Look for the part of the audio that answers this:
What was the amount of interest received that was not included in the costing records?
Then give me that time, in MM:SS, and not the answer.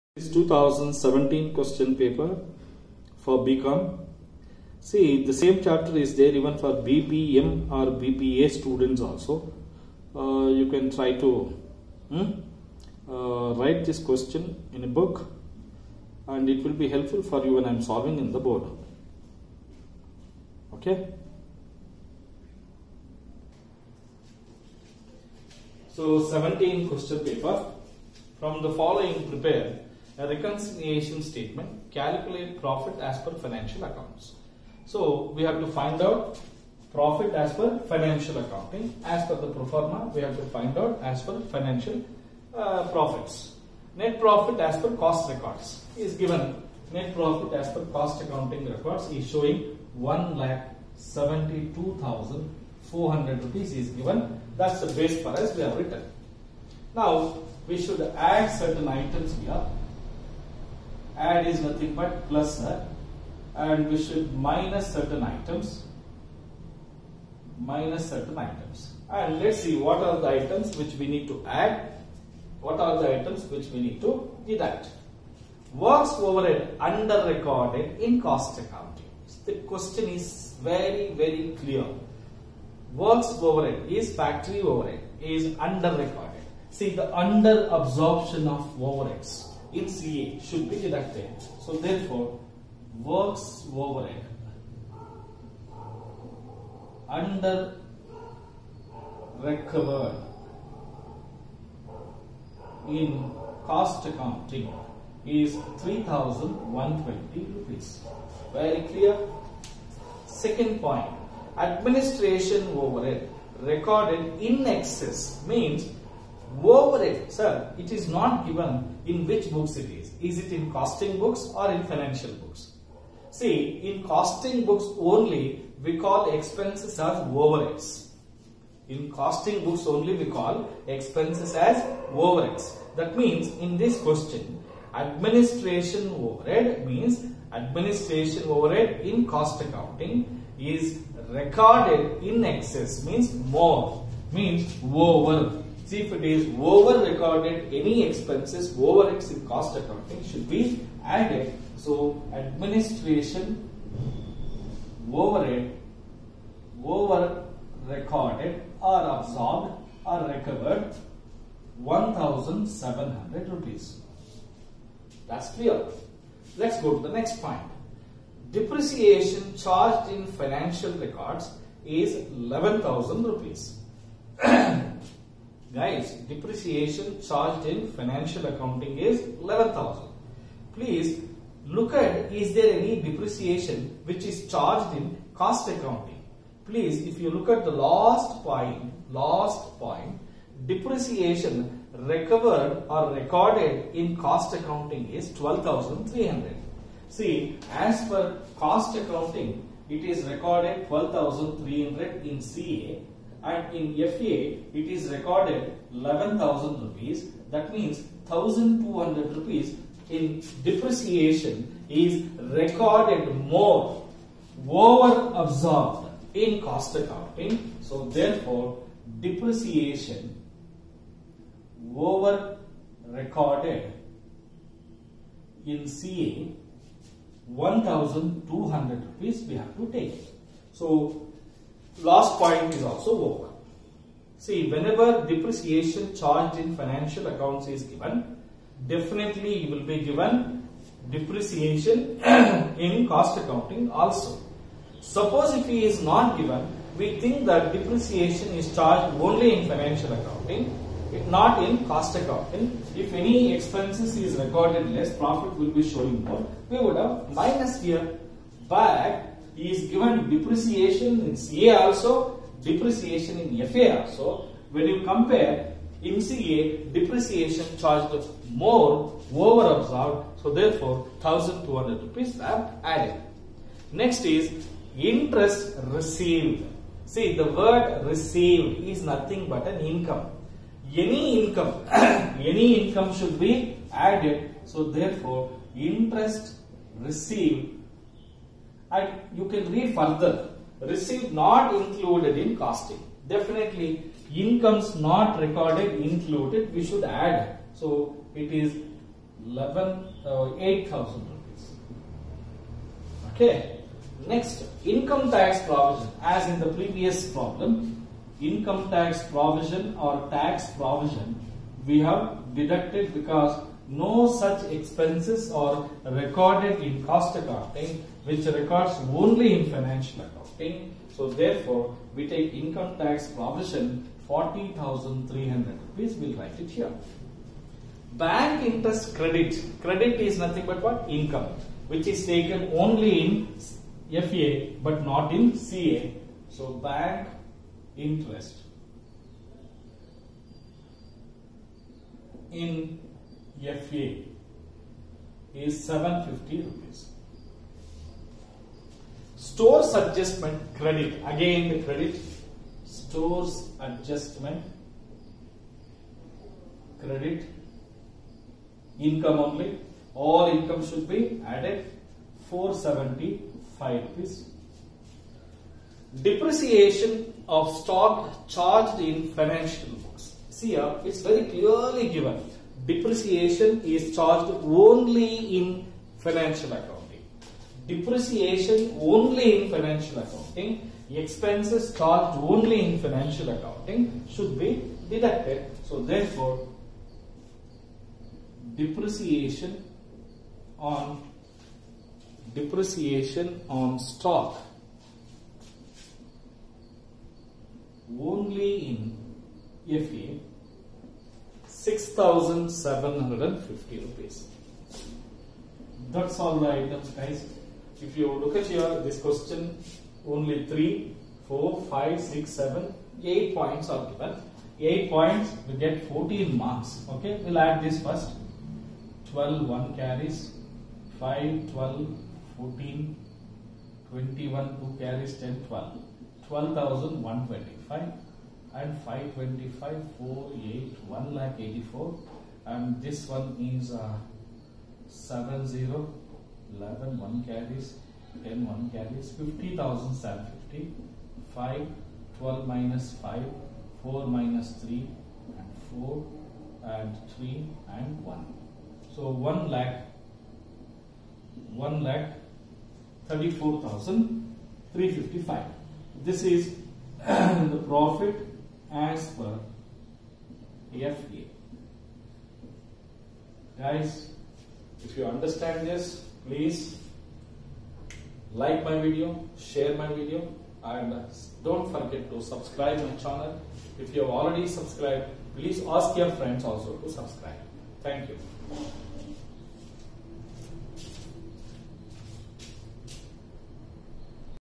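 05:00.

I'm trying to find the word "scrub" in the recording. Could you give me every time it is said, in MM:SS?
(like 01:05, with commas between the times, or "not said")
not said.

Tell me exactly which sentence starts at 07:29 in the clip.
So 1 lakh, 1 lakh 34,355.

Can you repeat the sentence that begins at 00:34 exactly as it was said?
So we have to find out profit as per financial accounting.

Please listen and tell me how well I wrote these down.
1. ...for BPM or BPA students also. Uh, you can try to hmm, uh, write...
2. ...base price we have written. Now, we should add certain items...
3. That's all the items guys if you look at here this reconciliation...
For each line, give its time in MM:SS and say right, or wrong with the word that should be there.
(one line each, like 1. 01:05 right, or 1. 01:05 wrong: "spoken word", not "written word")
1. 00:06 right
2. 00:54 right
3. 06:46 wrong: "question", not "reconciliation".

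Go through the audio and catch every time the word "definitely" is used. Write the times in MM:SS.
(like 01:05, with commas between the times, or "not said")
03:58, 04:53.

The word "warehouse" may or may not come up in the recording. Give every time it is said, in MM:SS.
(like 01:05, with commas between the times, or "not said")
not said.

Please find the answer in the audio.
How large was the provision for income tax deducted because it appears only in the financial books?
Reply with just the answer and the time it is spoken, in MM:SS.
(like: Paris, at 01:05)
40,300 rupees, at 05:24.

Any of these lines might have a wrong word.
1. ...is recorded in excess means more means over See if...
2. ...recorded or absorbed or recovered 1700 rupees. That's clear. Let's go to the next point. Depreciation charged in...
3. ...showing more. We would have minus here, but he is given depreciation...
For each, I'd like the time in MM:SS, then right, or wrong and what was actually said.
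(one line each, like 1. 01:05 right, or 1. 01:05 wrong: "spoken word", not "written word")
1. 02:20 right
2. 02:37 right
3. 04:15 right.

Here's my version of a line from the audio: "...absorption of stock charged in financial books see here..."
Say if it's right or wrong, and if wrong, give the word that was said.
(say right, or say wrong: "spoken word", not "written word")
wrong: "depreciation", not "absorption".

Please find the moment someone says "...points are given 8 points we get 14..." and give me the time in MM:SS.
06:53.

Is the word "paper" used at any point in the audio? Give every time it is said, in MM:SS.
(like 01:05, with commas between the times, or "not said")
00:01, 00:27.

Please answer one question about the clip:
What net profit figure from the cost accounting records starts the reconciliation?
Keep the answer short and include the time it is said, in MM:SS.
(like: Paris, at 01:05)
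172,400 rupees, at 00:49.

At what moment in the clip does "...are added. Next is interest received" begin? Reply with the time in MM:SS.
04:32.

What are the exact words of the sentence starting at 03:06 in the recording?
Please, if you look at the last point, last point, depreciation recovered or recorded in cost accounting is 12,300.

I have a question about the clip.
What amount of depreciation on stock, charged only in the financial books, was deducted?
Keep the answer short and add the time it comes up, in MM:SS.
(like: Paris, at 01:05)
6,750 rupees, at 06:41.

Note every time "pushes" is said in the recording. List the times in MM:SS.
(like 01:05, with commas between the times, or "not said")
not said.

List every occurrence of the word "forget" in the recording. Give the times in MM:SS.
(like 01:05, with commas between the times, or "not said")
07:51.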